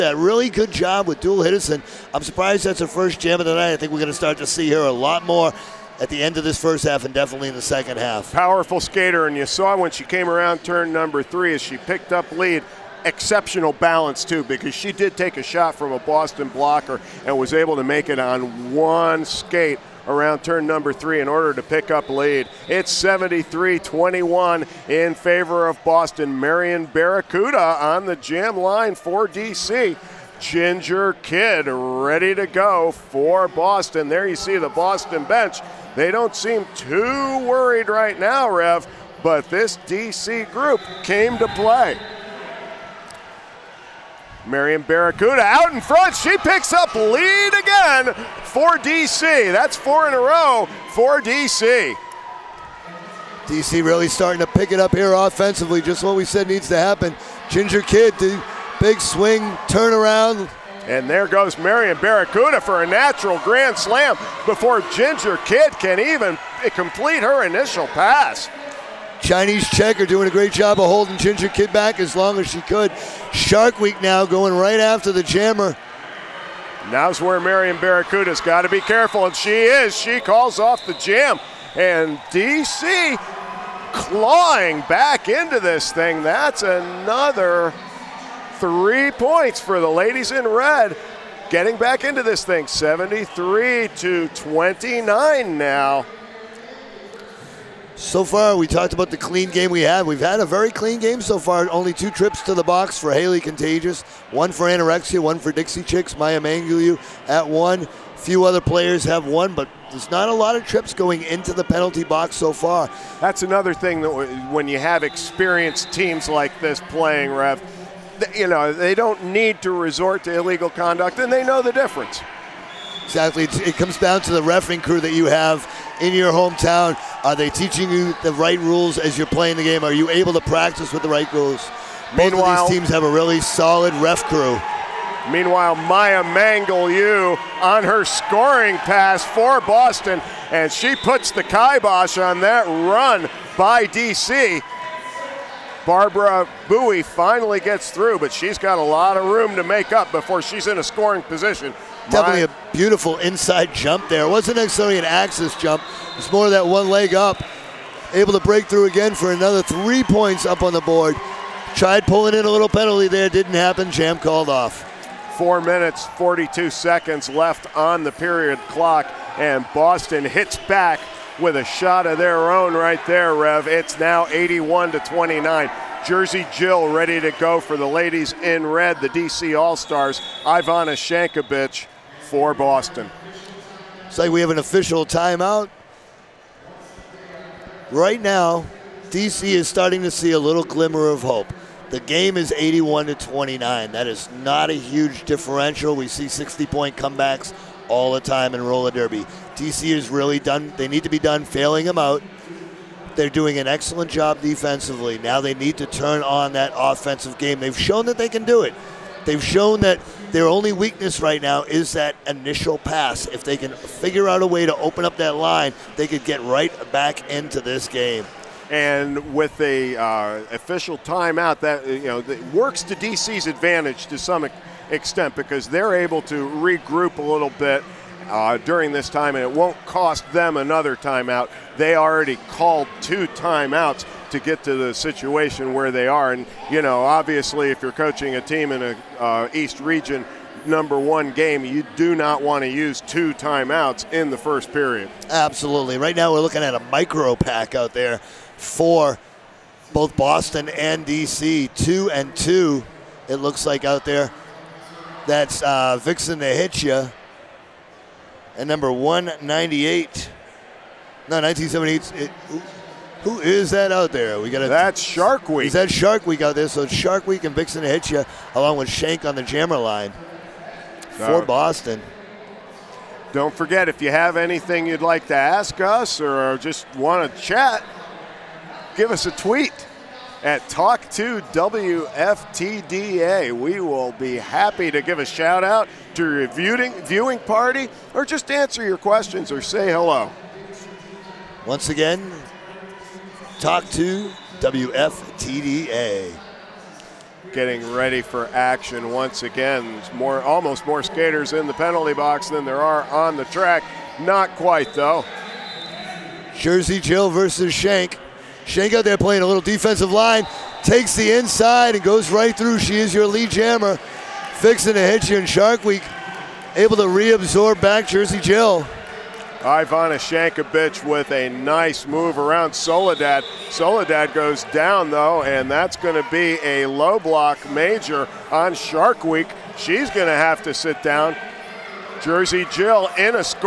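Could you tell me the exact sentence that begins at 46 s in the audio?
She picks up lead again for DC.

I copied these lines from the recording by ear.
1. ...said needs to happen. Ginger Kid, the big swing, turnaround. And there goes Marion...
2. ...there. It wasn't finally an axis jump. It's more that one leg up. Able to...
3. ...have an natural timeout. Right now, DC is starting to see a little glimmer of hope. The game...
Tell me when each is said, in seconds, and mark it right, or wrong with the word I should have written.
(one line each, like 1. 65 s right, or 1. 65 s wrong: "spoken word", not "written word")
1. 56 s right
2. 154 s wrong: "necessarily", not "finally"
3. 184 s wrong: "official", not "natural".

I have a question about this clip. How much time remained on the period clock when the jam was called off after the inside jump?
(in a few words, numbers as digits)
4 minutes 42 seconds.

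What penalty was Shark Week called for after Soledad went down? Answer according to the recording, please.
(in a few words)
Low block major.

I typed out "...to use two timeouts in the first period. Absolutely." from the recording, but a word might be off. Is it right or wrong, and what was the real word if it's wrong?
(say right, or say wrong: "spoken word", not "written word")
right.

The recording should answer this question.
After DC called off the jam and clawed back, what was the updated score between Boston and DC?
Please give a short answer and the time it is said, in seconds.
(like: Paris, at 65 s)
73 to 29, at 92 s.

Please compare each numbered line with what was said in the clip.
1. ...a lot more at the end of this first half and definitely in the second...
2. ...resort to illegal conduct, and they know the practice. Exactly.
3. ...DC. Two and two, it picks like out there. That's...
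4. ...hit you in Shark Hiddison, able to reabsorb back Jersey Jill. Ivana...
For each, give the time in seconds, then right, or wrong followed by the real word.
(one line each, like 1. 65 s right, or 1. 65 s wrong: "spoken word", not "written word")
1. 4 s right
2. 119 s wrong: "difference", not "practice"
3. 251 s wrong: "looks", not "picks"
4. 314 s wrong: "Week", not "Hiddison".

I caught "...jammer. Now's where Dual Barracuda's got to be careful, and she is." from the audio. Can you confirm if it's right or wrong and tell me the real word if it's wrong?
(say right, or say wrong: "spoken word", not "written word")
wrong: "Marion", not "Dual".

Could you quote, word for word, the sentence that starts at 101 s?
Only two trips to the box for Haley Contagious, one for Anorexia, one for Dixie Chicks, Maya Mangulu at one.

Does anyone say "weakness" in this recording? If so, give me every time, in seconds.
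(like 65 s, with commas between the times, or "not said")
210 s.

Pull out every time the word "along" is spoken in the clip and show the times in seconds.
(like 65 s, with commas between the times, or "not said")
268 s.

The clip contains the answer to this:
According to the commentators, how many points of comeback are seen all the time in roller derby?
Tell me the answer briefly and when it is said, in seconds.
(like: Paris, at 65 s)
60, at 196 s.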